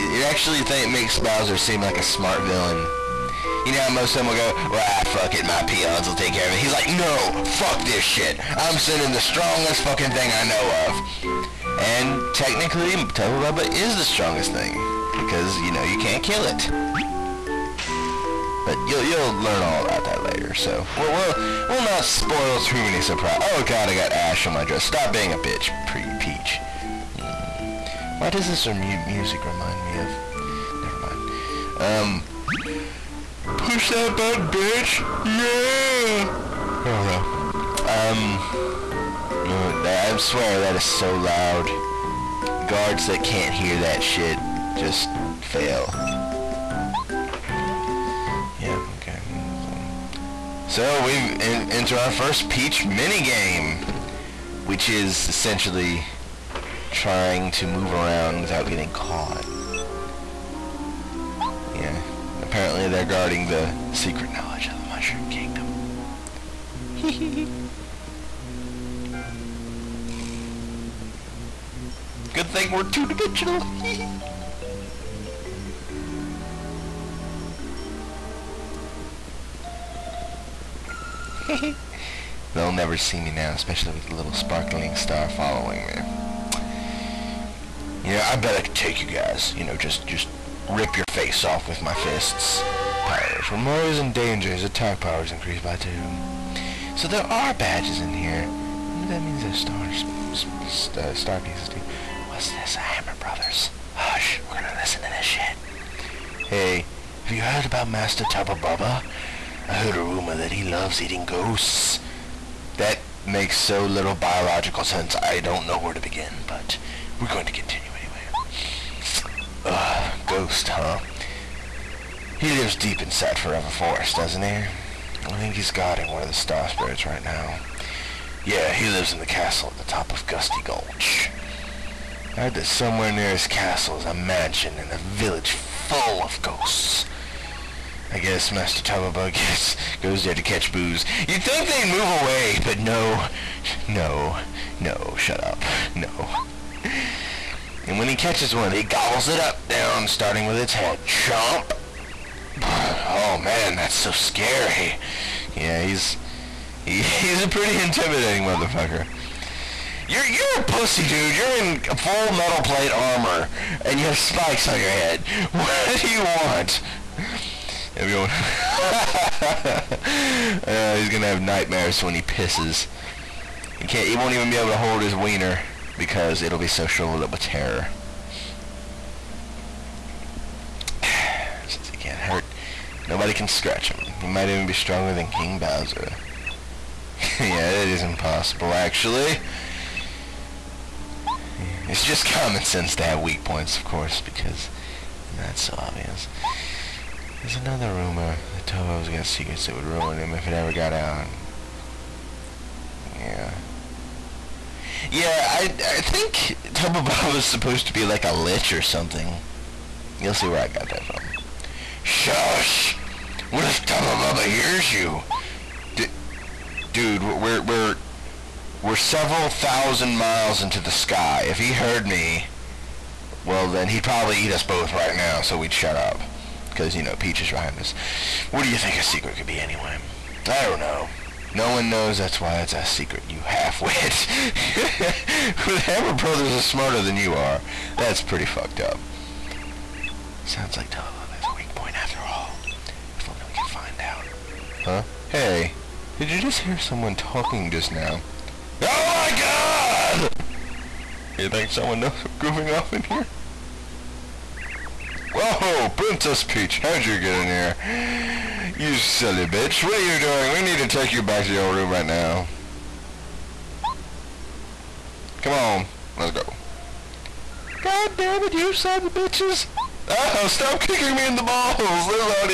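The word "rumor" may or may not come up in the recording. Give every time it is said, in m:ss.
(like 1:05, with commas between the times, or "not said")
1:49, 3:17.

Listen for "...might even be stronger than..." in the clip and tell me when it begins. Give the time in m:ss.
3:04.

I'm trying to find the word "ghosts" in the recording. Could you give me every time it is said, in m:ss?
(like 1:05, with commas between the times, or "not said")
1:51, 2:00, 2:16.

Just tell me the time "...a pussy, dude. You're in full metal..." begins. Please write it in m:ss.
2:40.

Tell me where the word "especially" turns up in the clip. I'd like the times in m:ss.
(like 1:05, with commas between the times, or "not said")
1:23.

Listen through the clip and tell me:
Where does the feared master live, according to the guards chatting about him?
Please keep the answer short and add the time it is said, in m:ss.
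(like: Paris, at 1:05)
Gusty Gulch, at 2:10.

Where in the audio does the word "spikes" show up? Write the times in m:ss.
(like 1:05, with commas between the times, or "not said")
2:44.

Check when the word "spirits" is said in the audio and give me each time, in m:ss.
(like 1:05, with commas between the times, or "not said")
2:06.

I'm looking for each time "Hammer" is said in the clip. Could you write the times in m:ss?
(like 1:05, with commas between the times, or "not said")
1:42, 3:55.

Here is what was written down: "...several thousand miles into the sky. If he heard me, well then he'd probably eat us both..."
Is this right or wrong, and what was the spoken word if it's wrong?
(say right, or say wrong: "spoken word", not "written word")
right.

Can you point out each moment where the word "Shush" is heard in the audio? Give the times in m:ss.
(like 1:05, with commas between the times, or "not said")
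3:32.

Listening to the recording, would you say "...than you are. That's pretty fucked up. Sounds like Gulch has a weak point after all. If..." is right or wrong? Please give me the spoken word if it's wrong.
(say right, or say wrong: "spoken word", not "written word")
wrong: "Telelobe", not "Gulch".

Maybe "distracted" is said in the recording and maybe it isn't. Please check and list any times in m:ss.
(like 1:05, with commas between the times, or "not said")
not said.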